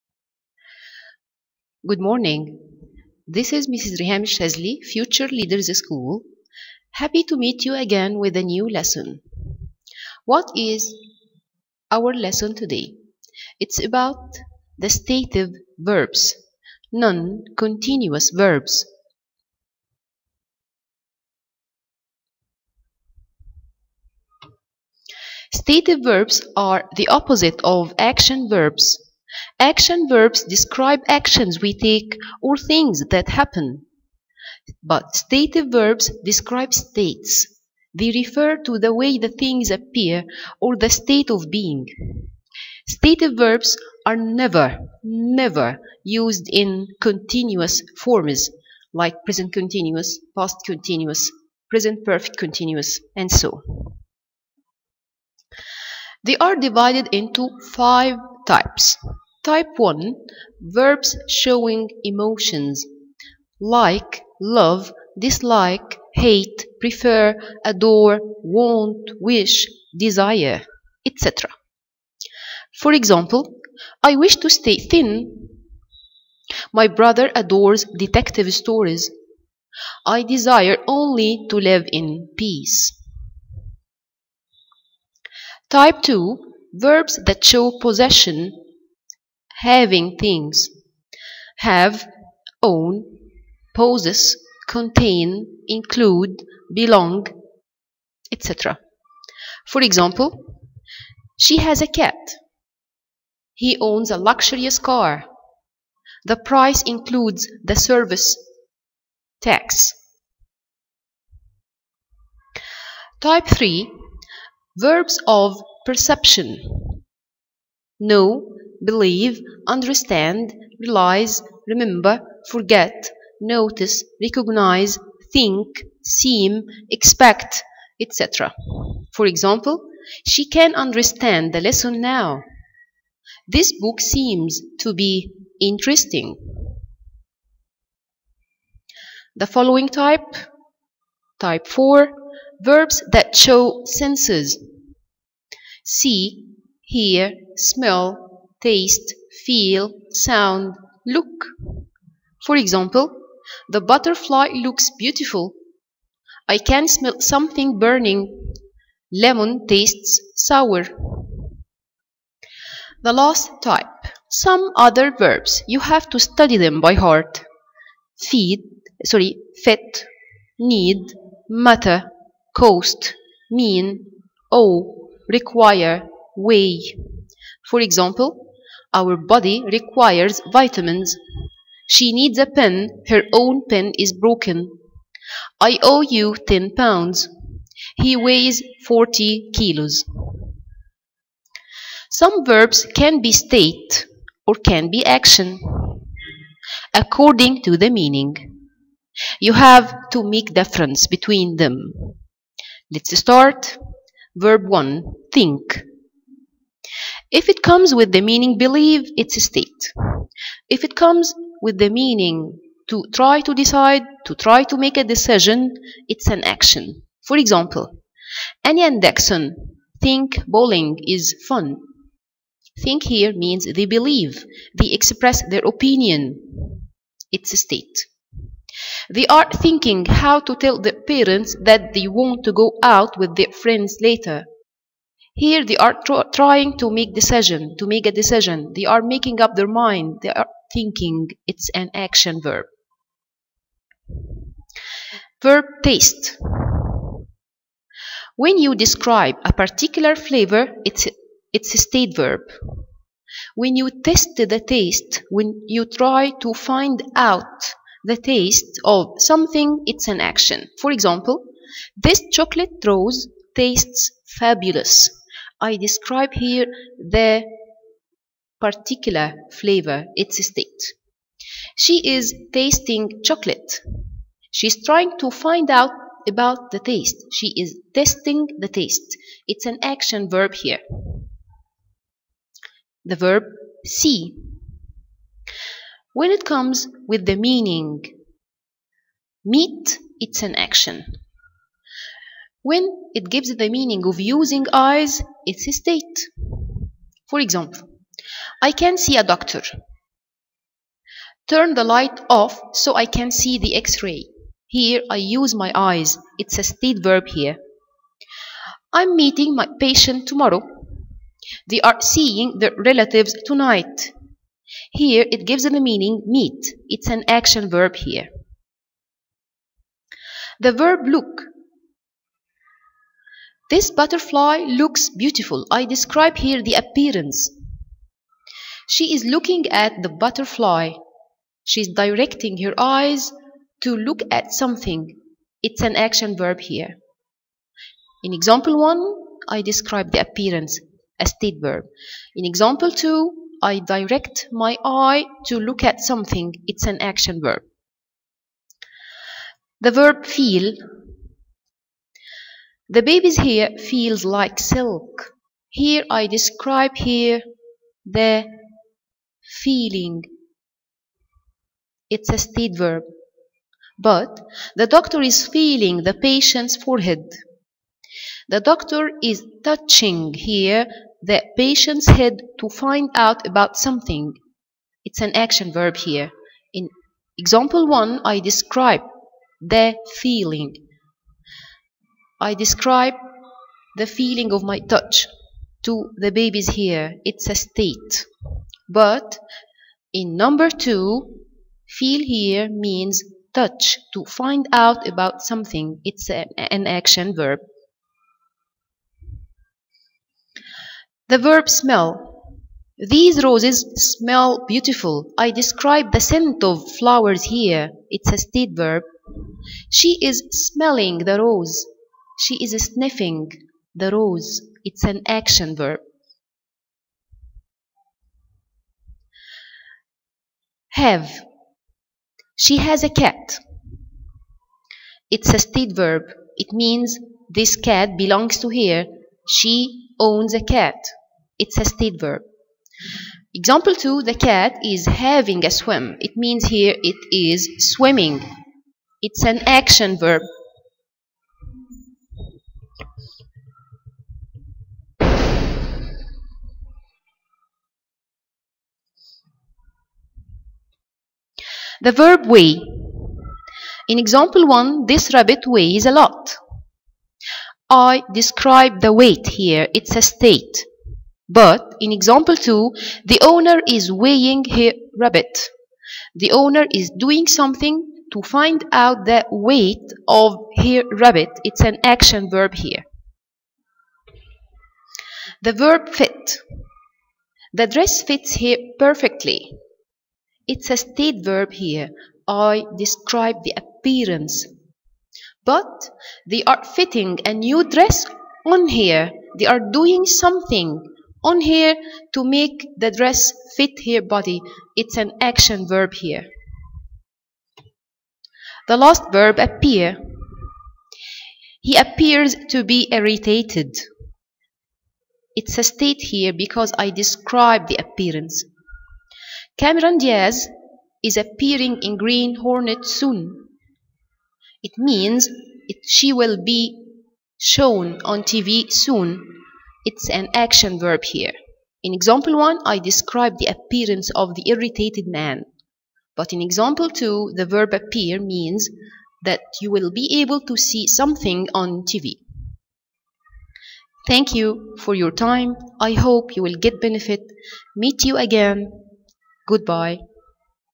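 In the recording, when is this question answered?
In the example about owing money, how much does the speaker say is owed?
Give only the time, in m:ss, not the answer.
3:06.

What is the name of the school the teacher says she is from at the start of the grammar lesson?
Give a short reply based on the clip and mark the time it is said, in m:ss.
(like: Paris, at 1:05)
Future Leaders School, at 0:04.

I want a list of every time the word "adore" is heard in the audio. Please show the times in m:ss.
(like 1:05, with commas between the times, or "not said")
1:07, 1:17.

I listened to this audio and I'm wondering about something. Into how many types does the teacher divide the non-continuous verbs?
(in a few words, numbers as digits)
5.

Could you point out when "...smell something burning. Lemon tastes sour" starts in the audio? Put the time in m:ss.
2:36.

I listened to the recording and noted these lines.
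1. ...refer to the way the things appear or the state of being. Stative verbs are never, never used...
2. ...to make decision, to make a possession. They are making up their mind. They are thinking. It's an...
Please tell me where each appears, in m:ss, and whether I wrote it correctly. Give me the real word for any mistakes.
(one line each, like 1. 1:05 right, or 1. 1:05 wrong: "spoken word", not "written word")
1. 0:38 right
2. 3:56 wrong: "decision", not "possession".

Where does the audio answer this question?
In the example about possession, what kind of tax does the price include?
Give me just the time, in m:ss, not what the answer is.
1:47.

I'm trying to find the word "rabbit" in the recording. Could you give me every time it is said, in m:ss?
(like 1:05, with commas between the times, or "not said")
7:35, 7:45, 7:51.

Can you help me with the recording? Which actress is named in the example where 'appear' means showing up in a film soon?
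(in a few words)
Cameron Diaz.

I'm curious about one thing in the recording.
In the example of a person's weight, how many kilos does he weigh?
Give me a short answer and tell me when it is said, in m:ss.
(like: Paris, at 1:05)
40 kilos, at 3:08.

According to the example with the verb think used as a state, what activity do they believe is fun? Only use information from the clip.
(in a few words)
Bowling.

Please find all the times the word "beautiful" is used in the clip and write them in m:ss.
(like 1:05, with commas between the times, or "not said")
2:34, 5:25, 6:44.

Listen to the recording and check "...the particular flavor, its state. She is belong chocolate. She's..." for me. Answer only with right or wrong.
wrong.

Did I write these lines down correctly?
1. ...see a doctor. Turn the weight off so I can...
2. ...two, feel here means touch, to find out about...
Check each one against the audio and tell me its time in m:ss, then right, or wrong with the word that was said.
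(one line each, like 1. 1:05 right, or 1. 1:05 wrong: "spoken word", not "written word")
1. 4:58 wrong: "light", not "weight"
2. 6:30 right.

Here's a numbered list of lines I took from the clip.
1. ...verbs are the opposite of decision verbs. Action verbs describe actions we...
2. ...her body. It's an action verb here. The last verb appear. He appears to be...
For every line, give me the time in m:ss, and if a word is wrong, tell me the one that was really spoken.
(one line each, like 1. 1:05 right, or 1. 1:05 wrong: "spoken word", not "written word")
1. 0:26 wrong: "action", not "decision"
2. 8:14 right.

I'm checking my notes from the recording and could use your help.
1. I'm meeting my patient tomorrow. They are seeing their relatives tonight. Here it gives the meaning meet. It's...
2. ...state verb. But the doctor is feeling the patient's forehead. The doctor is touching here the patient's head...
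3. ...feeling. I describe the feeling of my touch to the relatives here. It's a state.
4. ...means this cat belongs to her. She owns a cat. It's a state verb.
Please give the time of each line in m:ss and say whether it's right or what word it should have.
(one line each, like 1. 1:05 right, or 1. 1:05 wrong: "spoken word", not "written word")
1. 5:08 right
2. 6:02 right
3. 6:20 wrong: "babies", not "relatives"
4. 7:06 right.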